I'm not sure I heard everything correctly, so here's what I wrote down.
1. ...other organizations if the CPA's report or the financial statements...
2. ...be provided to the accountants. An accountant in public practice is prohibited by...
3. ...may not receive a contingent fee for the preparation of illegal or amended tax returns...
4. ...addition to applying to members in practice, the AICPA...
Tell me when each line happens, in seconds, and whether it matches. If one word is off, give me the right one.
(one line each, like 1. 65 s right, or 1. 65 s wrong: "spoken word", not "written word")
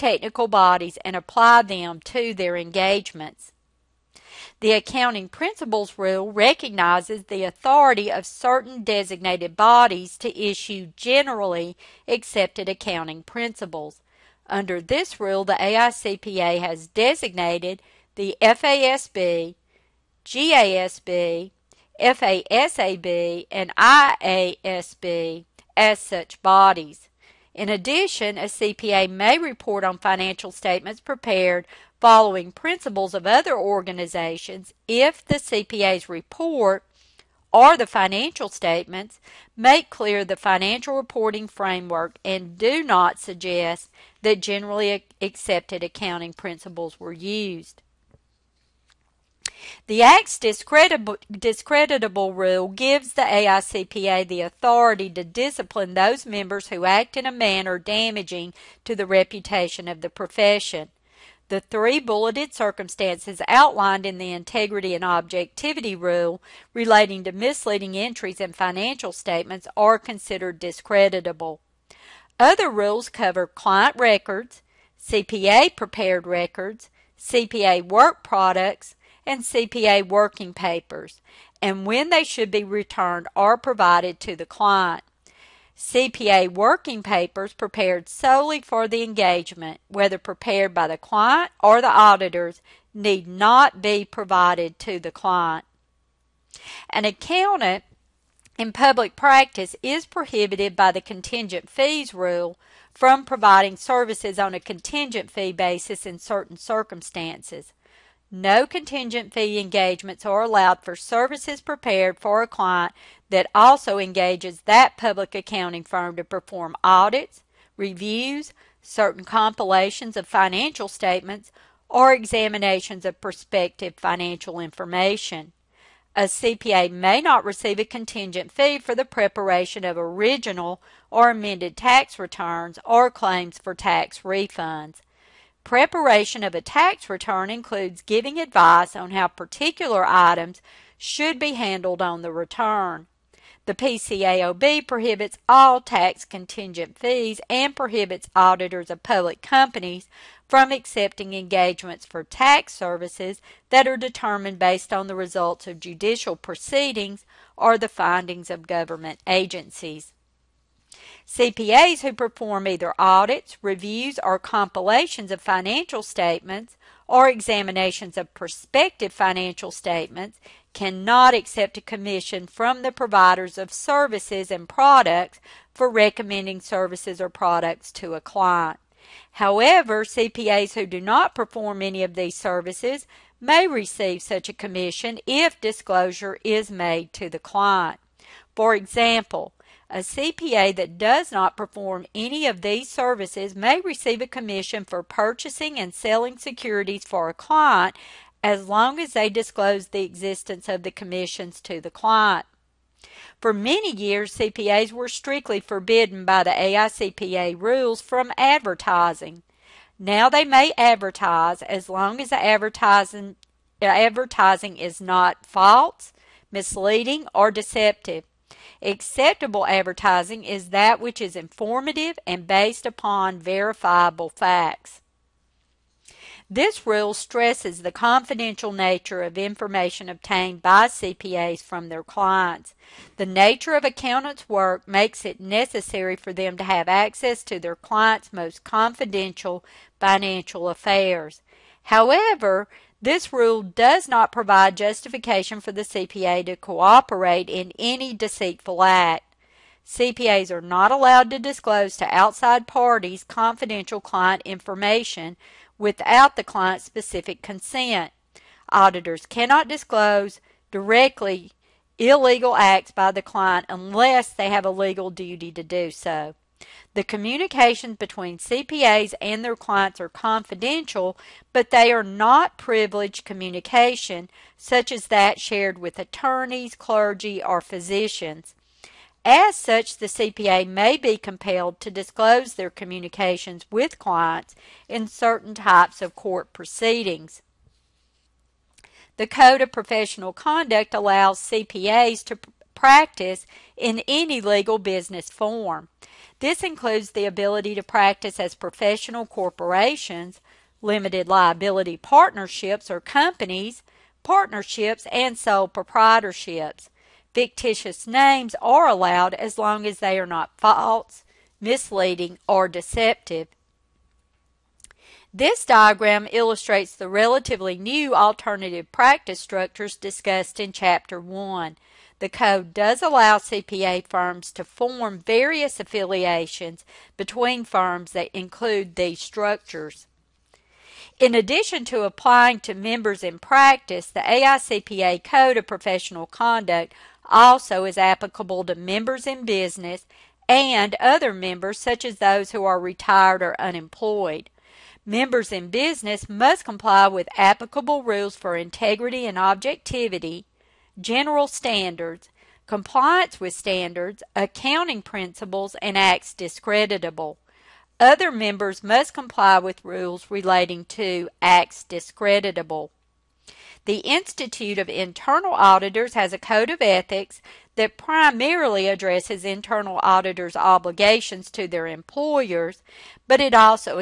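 1. 33 s right
2. 93 s wrong: "client", not "accountants"
3. 126 s wrong: "original", not "illegal"
4. 331 s right.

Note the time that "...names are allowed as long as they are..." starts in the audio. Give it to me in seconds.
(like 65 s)
308 s.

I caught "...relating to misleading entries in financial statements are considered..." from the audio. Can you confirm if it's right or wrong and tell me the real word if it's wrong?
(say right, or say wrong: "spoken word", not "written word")
right.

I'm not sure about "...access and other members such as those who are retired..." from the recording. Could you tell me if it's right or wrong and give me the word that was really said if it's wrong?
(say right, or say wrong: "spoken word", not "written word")
wrong: "business", not "access".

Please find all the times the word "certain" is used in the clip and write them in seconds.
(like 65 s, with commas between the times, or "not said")
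8 s, 106 s, 118 s, 285 s.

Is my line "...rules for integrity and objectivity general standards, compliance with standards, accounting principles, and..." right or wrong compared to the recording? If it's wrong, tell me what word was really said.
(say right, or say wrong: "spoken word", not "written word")
right.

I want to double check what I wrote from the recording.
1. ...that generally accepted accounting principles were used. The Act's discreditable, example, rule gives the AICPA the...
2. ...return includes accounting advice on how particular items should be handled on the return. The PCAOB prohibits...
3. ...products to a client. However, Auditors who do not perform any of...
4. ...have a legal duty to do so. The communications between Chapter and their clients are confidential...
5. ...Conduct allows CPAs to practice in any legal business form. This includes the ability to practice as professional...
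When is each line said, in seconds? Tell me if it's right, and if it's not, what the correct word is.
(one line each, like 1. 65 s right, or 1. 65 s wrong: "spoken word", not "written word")
1. 44 s wrong: "discreditable", not "example"
2. 137 s wrong: "giving", not "accounting"
3. 177 s wrong: "CPAs", not "Auditors"
4. 264 s wrong: "CPAs", not "Chapter"
5. 290 s right.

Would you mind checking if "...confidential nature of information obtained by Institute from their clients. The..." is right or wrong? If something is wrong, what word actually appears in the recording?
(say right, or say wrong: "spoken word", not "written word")
wrong: "CPAs", not "Institute".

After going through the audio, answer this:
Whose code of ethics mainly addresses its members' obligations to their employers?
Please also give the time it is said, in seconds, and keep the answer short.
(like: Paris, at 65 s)
Institute of Internal Auditors, at 363 s.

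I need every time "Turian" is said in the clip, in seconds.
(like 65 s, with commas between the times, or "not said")
not said.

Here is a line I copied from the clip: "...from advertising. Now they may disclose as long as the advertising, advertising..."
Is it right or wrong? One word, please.
wrong.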